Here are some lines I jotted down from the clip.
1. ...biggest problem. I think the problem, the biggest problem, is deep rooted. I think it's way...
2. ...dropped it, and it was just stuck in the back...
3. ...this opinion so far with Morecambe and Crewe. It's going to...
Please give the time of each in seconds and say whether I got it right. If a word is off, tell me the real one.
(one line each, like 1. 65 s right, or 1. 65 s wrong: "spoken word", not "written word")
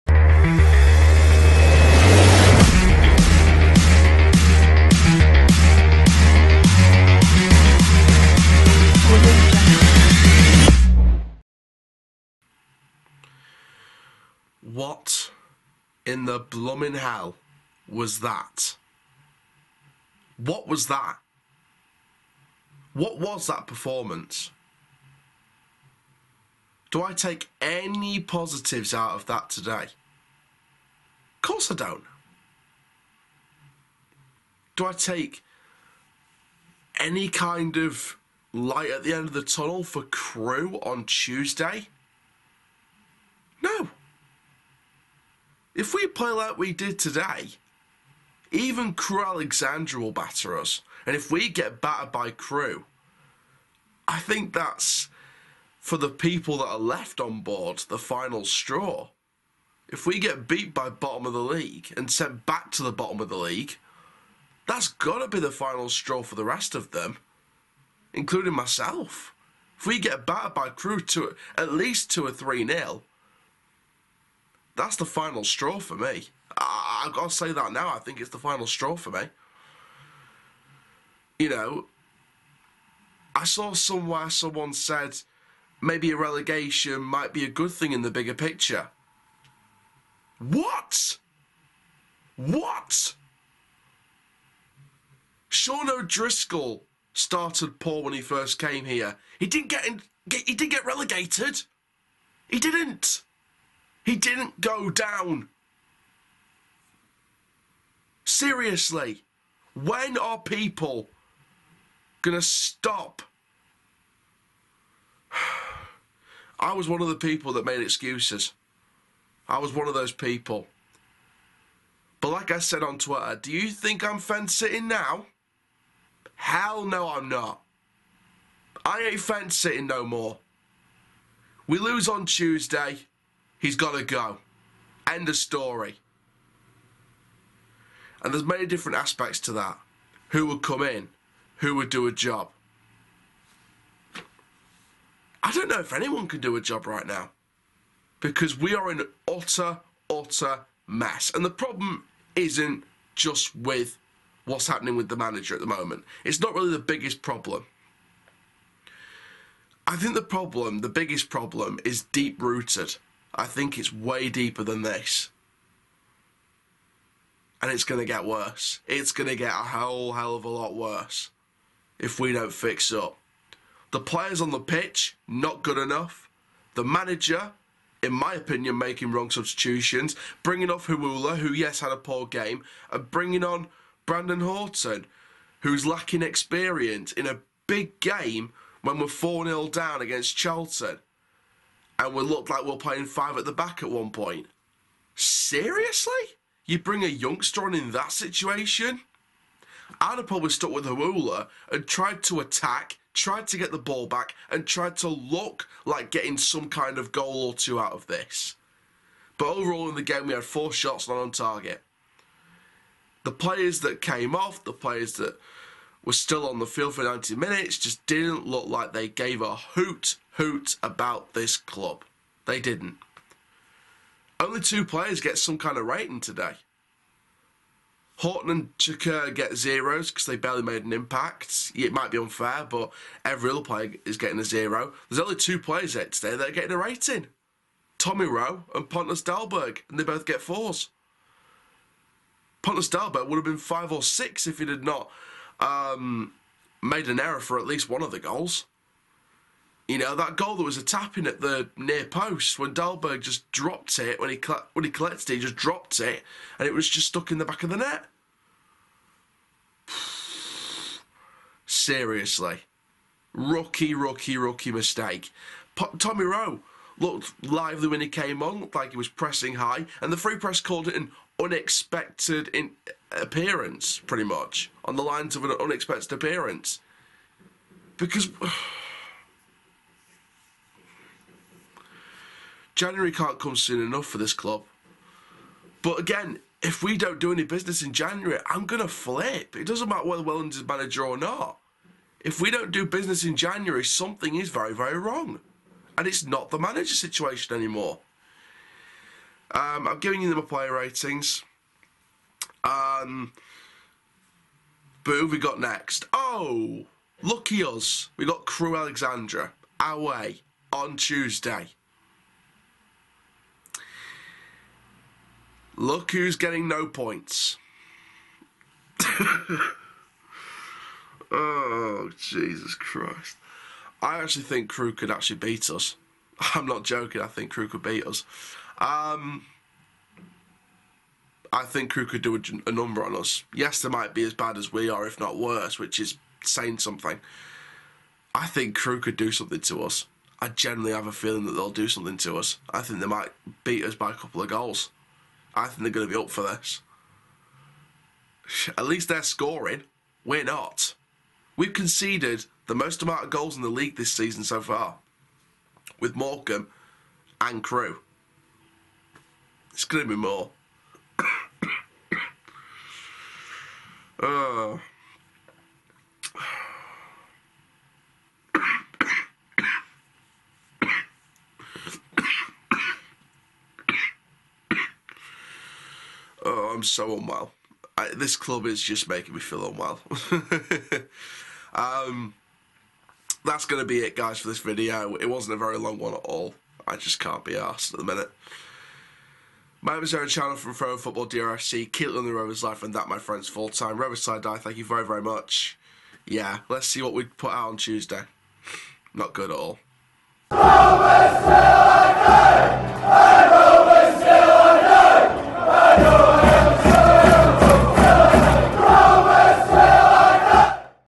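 1. 156 s right
2. 255 s right
3. 353 s wrong: "season", not "opinion".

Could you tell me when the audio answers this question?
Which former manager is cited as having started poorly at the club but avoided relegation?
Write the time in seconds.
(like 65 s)
95 s.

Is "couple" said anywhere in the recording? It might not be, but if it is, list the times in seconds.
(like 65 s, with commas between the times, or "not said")
344 s.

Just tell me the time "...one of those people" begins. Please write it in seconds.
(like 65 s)
119 s.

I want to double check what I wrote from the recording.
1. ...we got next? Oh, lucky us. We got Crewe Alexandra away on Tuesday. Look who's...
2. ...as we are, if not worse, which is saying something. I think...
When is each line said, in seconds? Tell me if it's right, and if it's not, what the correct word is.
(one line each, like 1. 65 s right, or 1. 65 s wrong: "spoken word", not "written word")
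1. 305 s right
2. 334 s right.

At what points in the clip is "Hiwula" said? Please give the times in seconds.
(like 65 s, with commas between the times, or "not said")
180 s, 200 s.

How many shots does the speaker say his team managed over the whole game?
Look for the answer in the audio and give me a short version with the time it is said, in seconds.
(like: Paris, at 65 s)
4, at 210 s.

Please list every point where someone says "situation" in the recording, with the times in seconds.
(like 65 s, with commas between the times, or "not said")
198 s, 296 s.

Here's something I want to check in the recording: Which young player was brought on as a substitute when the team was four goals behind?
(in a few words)
Brandon Horton.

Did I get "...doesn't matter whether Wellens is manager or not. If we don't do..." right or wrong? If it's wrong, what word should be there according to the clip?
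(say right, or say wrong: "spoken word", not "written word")
right.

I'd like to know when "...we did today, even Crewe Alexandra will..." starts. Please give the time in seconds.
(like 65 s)
46 s.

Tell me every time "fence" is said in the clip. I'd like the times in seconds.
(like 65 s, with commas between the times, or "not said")
124 s, 129 s.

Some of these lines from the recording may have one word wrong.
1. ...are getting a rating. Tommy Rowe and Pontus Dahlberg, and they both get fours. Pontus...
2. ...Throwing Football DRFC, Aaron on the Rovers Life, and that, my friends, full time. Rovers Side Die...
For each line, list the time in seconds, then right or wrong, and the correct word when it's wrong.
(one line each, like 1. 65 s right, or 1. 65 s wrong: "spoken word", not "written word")
1. 236 s right
2. 390 s wrong: "Keelan", not "Aaron".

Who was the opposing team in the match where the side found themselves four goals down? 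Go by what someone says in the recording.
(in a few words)
Charlton.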